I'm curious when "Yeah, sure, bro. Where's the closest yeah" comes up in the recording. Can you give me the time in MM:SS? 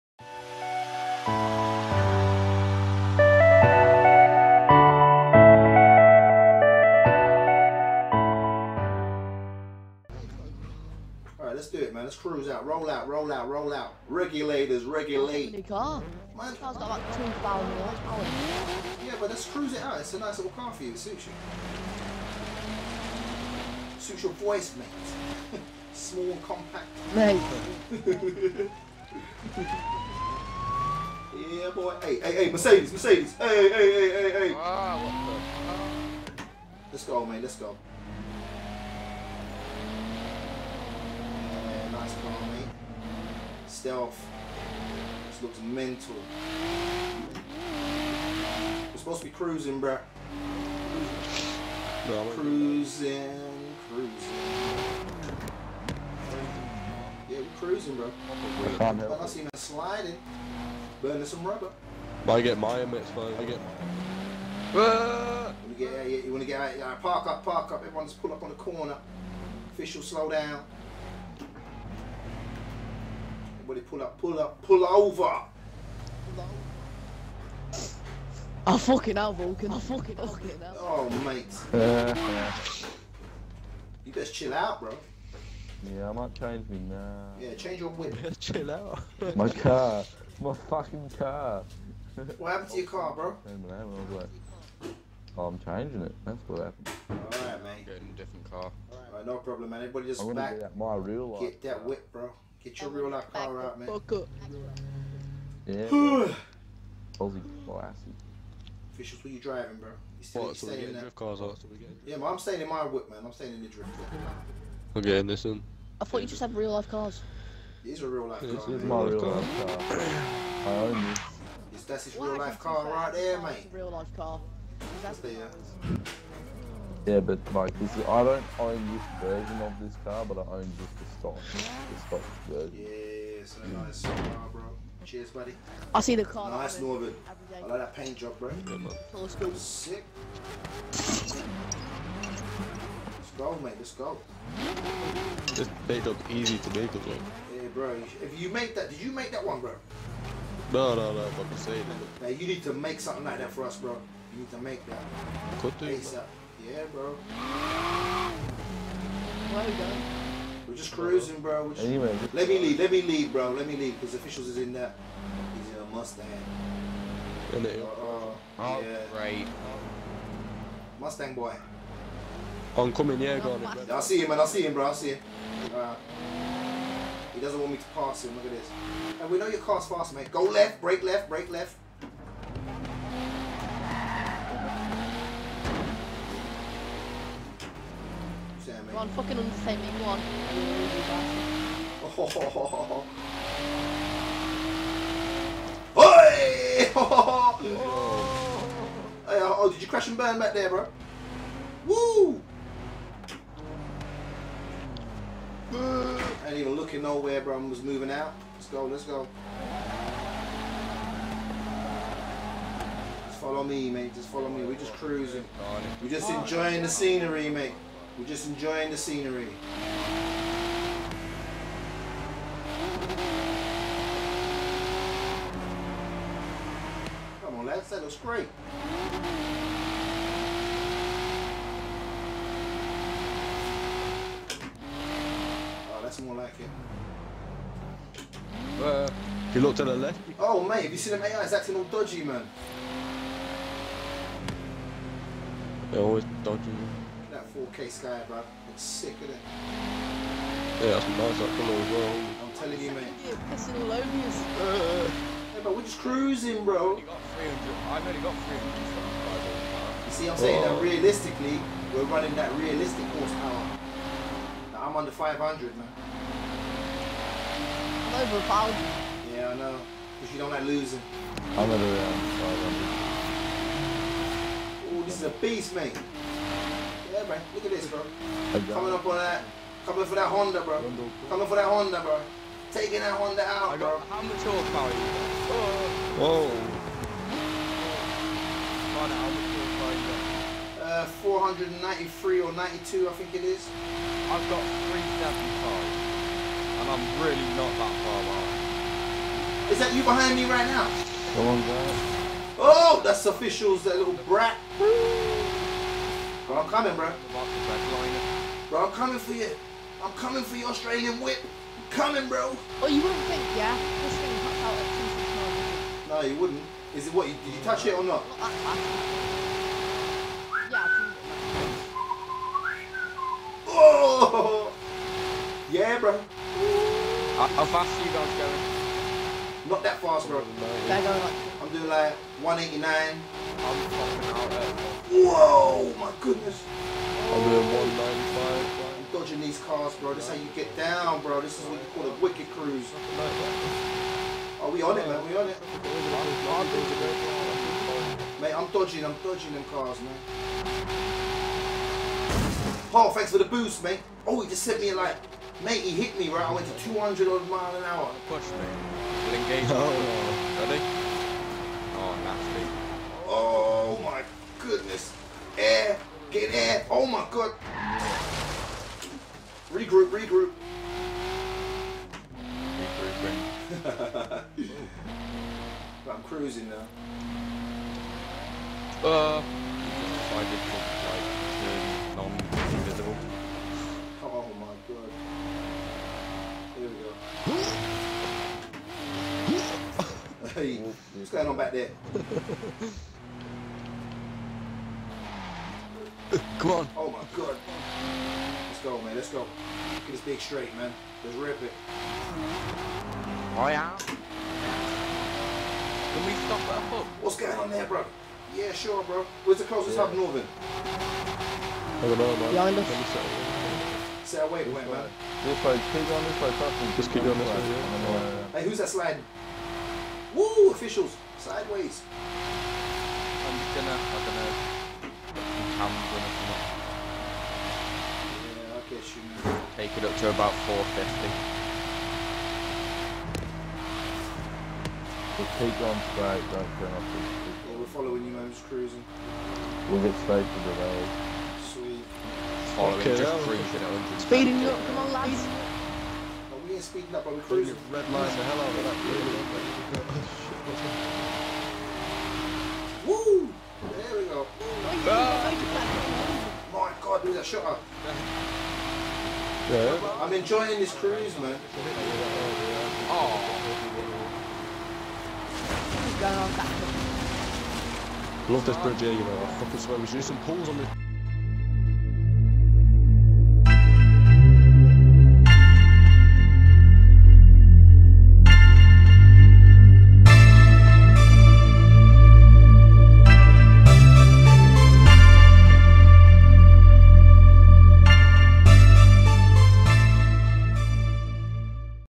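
06:48.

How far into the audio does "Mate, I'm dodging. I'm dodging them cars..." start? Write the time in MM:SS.
05:48.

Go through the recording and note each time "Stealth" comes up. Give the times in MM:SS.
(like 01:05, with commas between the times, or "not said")
00:43.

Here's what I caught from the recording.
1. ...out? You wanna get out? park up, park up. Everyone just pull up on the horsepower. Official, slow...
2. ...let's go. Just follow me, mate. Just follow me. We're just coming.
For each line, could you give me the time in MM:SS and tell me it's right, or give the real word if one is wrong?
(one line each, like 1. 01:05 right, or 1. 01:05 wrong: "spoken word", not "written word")
1. 01:05 wrong: "corner", not "horsepower"
2. 03:28 wrong: "cruising", not "coming".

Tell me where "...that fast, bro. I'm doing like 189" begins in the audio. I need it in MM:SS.
05:29.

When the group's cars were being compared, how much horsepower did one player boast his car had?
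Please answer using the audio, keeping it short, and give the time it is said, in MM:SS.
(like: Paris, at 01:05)
2,000, at 00:17.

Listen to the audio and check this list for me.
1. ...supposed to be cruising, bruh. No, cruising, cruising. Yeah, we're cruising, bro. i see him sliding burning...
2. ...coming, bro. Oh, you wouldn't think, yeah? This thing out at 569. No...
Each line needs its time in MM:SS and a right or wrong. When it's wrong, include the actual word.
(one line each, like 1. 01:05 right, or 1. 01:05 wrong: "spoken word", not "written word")
1. 00:48 right
2. 05:11 wrong: "269", not "569".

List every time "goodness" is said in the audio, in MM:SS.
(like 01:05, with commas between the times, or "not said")
05:36, 06:04.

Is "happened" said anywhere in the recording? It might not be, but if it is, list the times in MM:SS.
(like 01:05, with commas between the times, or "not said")
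01:32, 01:36.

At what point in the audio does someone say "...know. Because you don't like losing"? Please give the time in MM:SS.
04:29.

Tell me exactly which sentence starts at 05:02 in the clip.
Oh, that's officials, that little brat.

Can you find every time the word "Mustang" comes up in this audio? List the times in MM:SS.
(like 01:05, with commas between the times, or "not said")
02:45, 02:50.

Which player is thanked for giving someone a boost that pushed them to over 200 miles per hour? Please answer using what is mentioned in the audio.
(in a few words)
Paul.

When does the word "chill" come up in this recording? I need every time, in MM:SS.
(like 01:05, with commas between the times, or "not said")
01:24, 01:28.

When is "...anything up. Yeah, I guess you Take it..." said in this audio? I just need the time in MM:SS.
07:06.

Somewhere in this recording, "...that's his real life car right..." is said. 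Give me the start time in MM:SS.
02:01.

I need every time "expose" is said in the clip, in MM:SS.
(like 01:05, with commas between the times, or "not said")
not said.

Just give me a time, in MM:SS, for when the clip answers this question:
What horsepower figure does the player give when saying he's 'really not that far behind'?
04:54.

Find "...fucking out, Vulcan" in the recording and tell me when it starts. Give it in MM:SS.
01:18.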